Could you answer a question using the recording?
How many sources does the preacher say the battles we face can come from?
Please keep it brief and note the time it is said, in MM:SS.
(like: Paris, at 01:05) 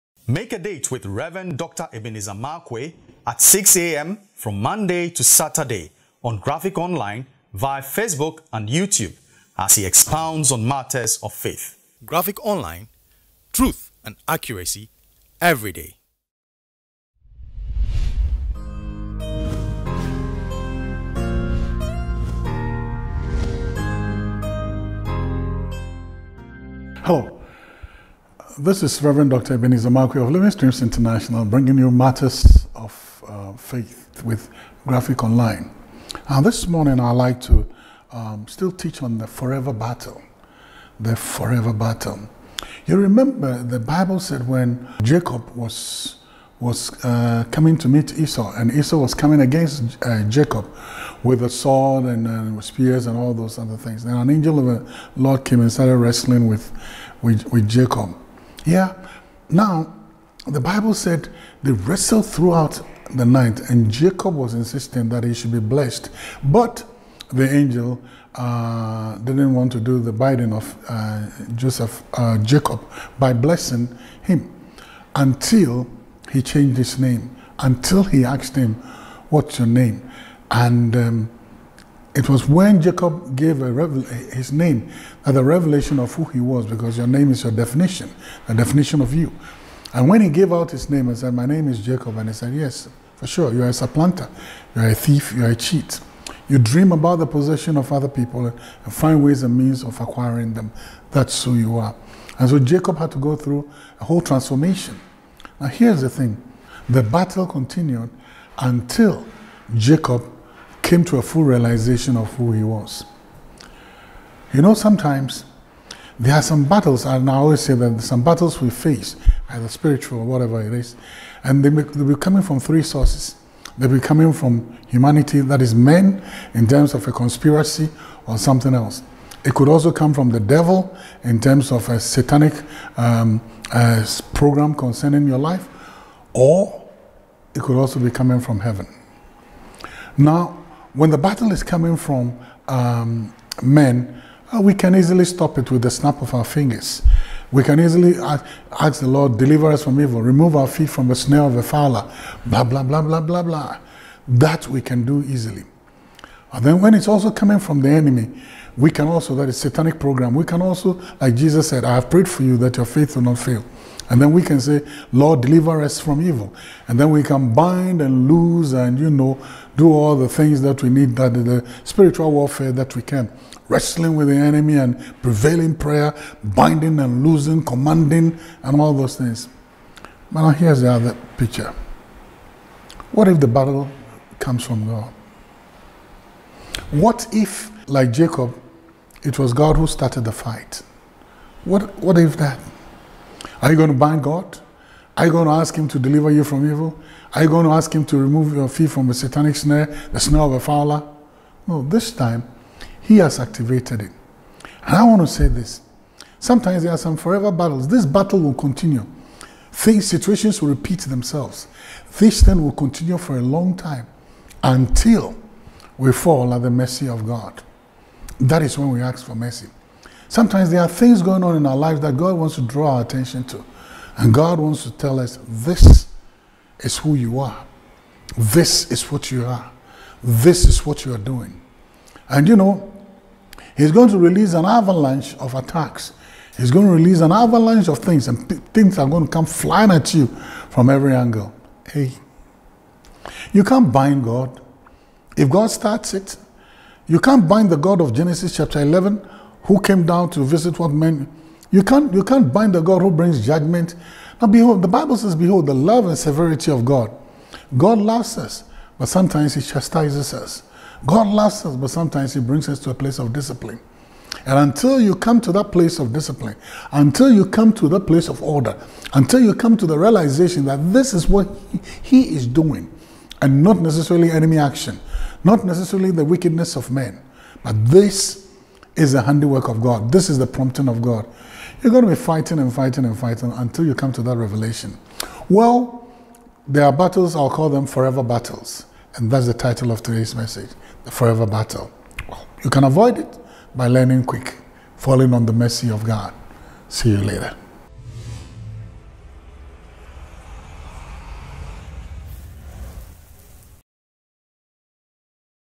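3, at 02:02.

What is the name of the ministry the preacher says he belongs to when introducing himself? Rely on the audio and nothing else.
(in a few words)
Living Streams International.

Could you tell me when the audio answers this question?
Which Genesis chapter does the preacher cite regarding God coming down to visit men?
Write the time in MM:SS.
04:08.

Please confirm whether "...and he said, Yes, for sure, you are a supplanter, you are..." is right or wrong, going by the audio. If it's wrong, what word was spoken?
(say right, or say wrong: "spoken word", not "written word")
right.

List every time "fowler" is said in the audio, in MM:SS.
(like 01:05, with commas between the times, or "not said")
02:31, 03:20.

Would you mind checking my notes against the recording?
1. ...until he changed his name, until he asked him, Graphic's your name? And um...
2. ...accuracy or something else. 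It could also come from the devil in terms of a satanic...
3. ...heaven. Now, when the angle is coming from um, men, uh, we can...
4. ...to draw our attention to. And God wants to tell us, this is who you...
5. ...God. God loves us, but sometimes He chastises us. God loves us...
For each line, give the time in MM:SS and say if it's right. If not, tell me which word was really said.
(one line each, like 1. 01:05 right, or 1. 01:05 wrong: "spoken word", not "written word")
1. 01:15 wrong: "What", not "Graphic"
2. 02:07 wrong: "conspiracy", not "accuracy"
3. 02:18 wrong: "battle", not "angle"
4. 03:42 right
5. 04:16 right.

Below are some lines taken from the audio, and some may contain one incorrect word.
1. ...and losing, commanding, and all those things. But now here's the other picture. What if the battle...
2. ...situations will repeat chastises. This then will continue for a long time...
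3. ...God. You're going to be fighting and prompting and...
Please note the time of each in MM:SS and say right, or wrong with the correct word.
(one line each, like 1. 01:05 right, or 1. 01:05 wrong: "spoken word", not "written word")
1. 02:56 right
2. 03:30 wrong: "themselves", not "chastises"
3. 04:41 wrong: "fighting", not "prompting".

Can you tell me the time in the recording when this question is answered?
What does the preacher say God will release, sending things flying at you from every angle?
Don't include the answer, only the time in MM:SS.
03:54.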